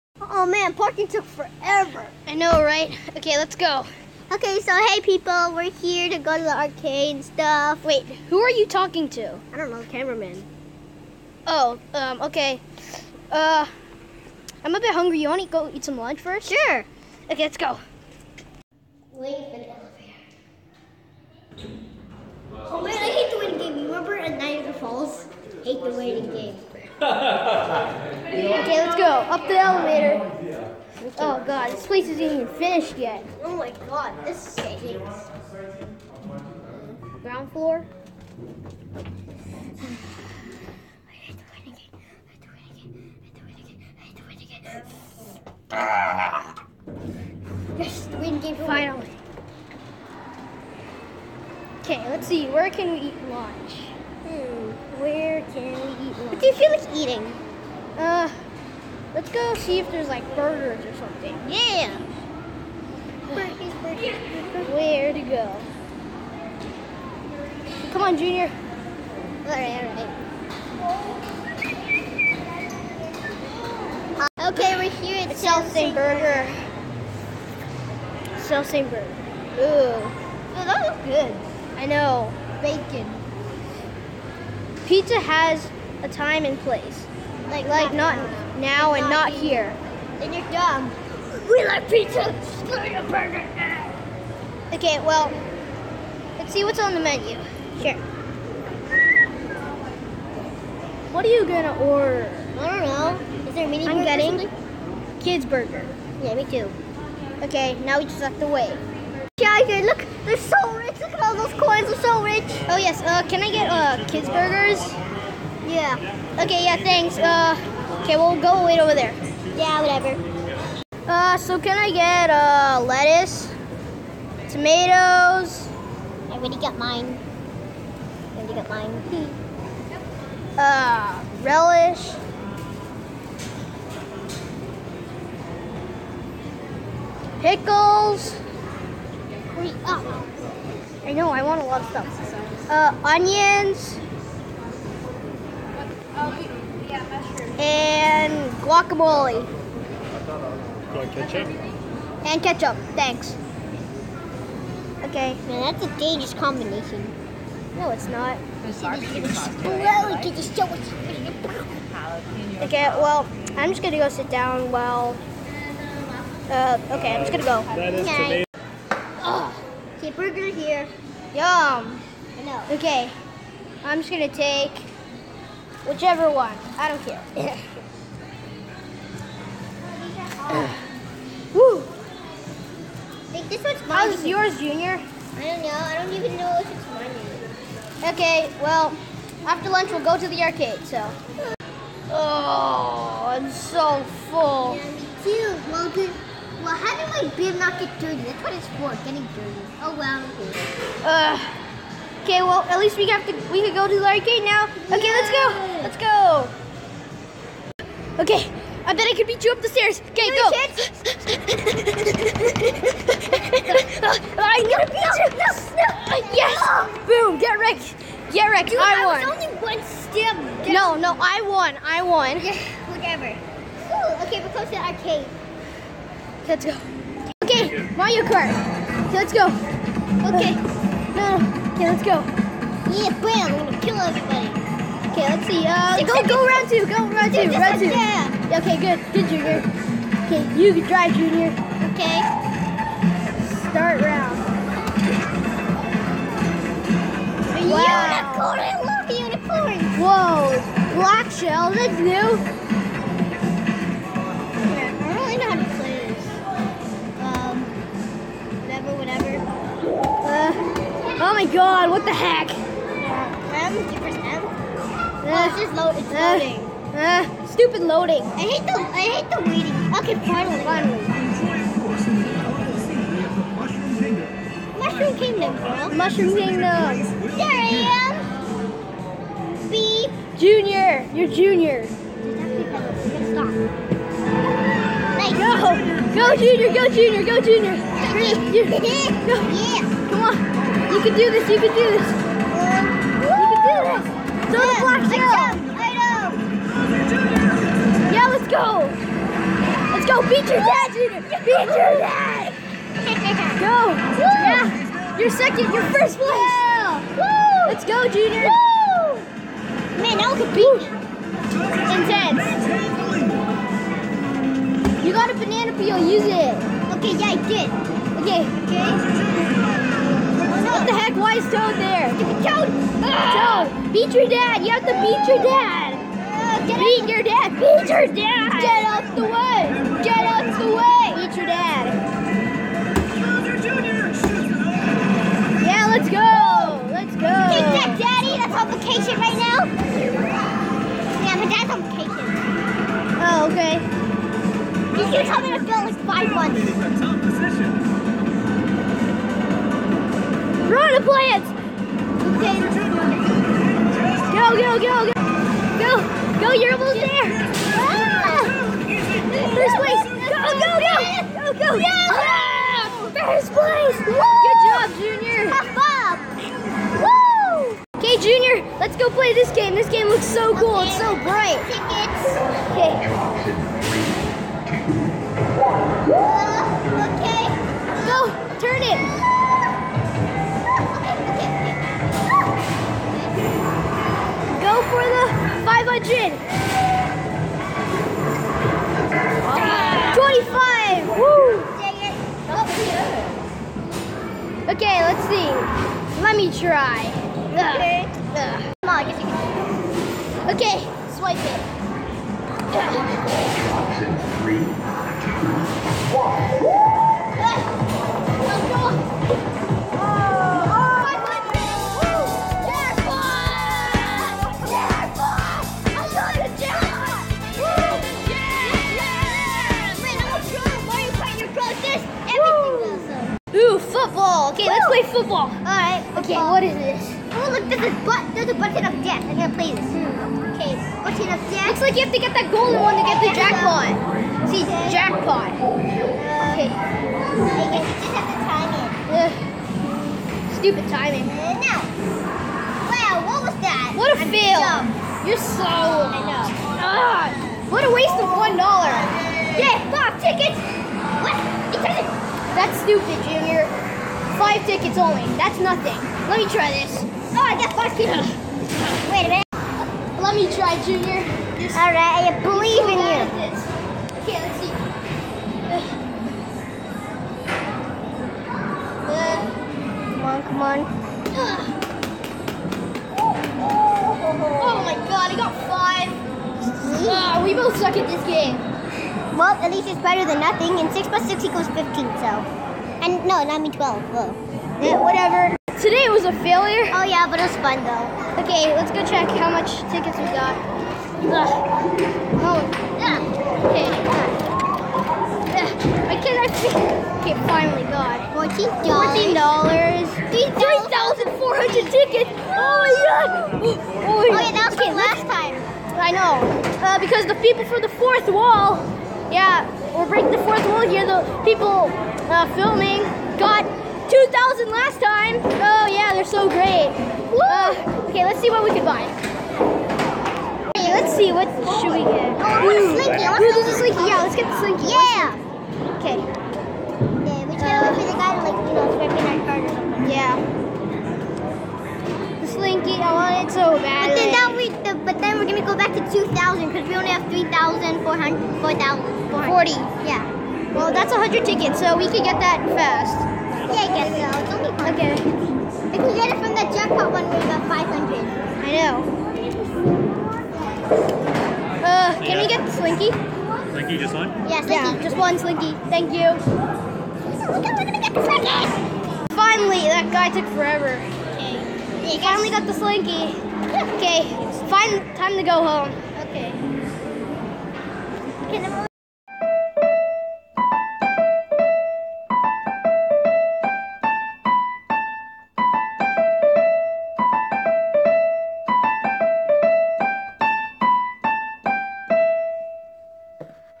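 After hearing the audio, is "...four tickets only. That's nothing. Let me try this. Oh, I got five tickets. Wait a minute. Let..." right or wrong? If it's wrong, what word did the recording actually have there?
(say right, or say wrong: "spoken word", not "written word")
wrong: "five", not "four".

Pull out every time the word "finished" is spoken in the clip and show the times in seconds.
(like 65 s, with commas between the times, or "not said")
32 s.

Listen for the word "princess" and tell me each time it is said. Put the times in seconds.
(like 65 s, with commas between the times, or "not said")
not said.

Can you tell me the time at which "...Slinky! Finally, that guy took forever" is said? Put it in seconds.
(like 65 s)
558 s.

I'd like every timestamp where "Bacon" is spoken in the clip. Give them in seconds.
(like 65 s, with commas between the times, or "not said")
82 s.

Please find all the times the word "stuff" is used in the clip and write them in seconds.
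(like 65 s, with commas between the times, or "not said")
7 s, 141 s.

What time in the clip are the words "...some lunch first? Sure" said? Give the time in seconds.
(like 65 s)
15 s.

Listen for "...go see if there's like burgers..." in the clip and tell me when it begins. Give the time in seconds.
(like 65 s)
59 s.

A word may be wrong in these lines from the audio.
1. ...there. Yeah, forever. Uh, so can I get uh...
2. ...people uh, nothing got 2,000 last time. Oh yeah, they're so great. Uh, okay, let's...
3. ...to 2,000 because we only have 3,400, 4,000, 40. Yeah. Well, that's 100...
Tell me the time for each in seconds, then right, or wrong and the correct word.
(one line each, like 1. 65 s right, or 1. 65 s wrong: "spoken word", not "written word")
1. 118 s wrong: "whatever", not "forever"
2. 511 s wrong: "filming", not "nothing"
3. 535 s right.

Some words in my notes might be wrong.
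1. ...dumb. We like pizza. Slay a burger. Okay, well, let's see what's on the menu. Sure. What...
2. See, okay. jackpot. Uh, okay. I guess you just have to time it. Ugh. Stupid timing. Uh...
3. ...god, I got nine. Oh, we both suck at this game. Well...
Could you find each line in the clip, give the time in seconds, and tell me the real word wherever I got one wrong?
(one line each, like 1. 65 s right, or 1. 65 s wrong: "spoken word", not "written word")
1. 90 s right
2. 434 s right
3. 475 s wrong: "five", not "nine".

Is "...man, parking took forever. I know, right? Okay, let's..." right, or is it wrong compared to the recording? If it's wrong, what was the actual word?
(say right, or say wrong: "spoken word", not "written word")
right.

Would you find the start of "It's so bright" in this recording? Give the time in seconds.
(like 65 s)
370 s.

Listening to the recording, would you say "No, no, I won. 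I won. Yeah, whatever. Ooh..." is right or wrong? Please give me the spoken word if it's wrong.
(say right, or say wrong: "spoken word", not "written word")
right.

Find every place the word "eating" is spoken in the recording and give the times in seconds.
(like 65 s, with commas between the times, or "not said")
56 s.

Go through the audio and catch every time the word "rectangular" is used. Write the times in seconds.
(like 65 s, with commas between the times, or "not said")
not said.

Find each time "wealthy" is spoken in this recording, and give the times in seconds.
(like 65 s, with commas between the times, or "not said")
not said.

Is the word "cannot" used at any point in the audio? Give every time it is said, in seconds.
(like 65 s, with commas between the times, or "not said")
496 s.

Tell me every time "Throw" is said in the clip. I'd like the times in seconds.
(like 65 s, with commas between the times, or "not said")
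294 s.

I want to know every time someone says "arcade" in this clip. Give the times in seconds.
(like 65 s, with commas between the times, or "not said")
6 s, 190 s, 204 s, 224 s.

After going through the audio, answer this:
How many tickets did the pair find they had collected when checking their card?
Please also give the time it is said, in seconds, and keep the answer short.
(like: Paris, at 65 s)
3,400, at 500 s.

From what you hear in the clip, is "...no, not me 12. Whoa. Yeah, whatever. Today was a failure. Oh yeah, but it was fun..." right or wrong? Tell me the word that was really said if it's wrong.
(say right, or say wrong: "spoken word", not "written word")
right.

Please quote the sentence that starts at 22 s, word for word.
Oh man, I hate the waiting game.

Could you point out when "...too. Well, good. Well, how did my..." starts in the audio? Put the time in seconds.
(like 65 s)
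195 s.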